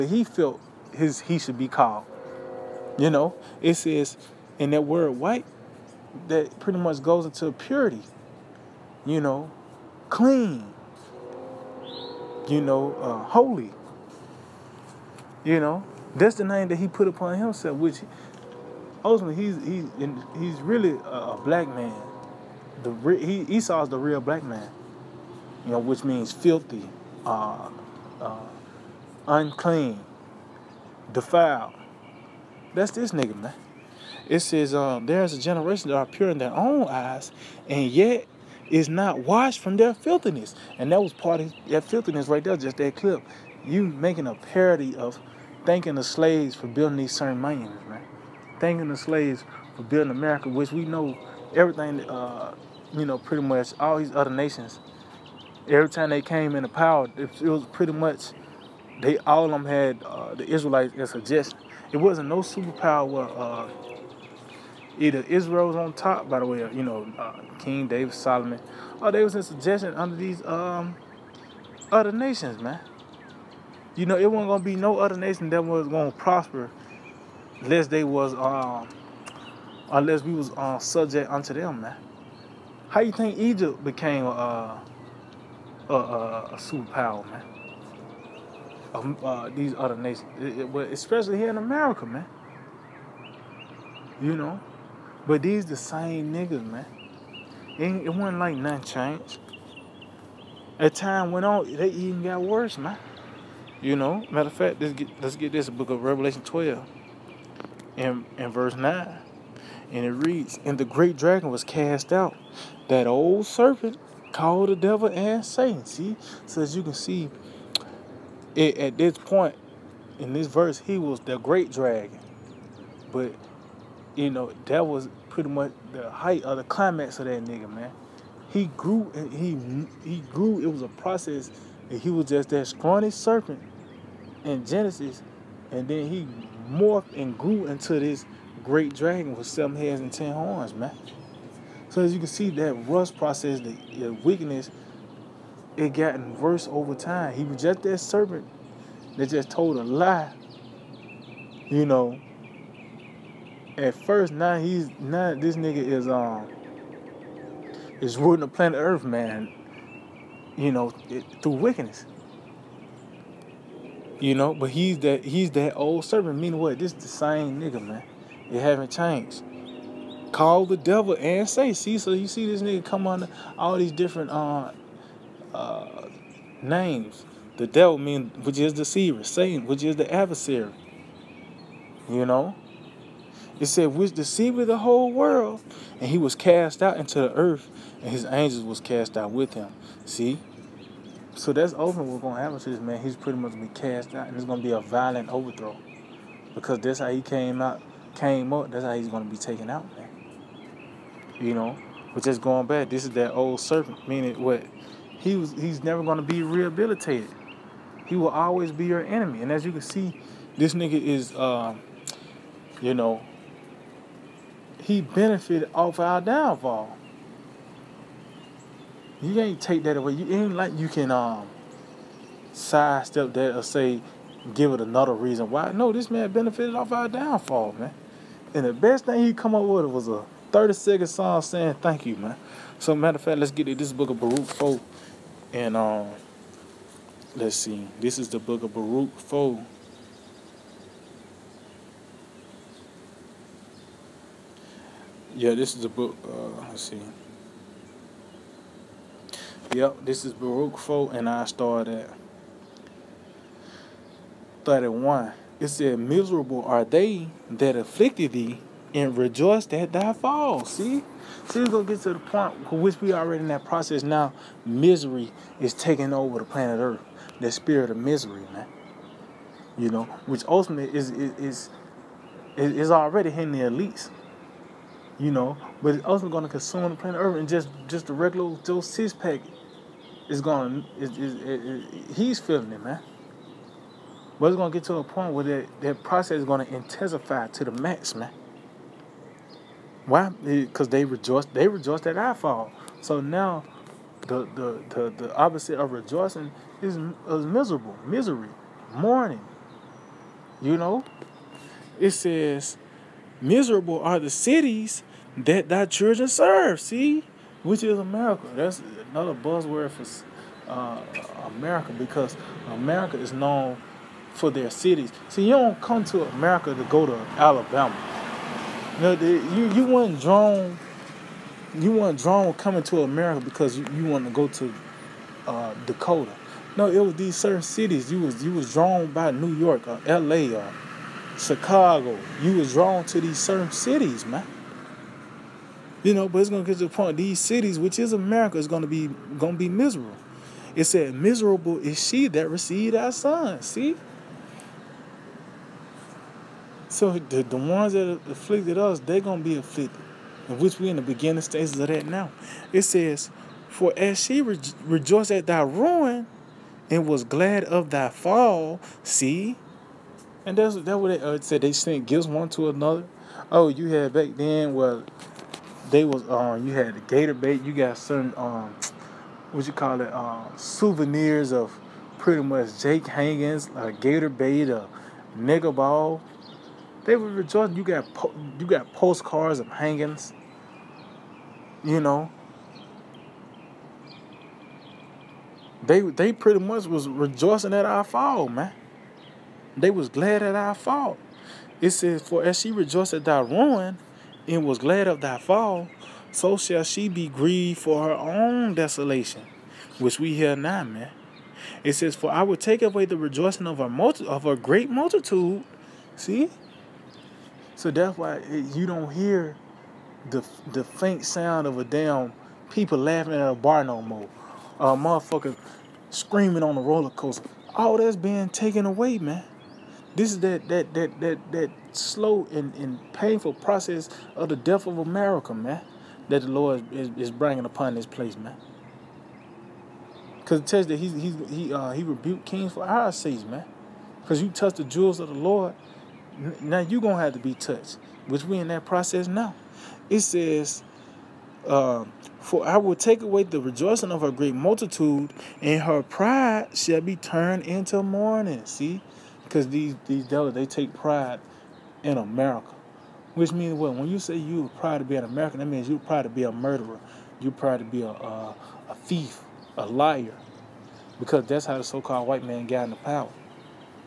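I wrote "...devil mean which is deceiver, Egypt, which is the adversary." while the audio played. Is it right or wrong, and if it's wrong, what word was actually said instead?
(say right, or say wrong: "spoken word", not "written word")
wrong: "Satan", not "Egypt".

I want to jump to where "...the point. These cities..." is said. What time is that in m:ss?
5:36.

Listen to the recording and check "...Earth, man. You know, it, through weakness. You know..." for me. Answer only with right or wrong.
wrong.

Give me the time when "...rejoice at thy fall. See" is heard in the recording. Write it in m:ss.
4:19.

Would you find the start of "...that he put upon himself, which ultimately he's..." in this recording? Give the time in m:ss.
0:16.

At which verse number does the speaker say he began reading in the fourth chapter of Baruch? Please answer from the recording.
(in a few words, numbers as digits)
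31.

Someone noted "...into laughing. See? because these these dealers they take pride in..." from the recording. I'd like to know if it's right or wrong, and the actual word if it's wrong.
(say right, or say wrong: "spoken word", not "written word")
wrong: "mourning", not "laughing".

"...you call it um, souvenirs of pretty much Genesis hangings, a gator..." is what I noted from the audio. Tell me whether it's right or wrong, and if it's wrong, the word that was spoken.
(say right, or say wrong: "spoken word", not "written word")
wrong: "Jake", not "Genesis".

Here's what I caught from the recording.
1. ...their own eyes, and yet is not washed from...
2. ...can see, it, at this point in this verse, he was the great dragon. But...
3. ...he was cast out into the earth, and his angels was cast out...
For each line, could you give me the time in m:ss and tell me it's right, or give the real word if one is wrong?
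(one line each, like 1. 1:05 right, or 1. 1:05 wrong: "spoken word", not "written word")
1. 0:36 right
2. 1:56 right
3. 3:06 right.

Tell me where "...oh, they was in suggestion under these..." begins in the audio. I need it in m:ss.
1:09.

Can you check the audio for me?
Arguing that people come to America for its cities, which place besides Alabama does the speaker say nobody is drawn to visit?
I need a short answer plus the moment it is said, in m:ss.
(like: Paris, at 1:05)
Dakota, at 5:25.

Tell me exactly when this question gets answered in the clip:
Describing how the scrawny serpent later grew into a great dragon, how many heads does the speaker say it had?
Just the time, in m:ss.
2:19.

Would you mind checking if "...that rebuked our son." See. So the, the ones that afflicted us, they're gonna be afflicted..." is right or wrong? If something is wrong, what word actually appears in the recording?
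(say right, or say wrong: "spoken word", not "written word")
wrong: "received", not "rebuked".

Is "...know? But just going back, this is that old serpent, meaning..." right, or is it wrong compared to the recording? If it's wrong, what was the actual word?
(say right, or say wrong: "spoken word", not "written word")
right.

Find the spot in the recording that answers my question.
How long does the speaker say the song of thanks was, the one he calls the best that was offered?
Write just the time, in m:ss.
3:50.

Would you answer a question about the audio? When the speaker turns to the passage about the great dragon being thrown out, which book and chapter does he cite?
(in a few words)
Revelation 12.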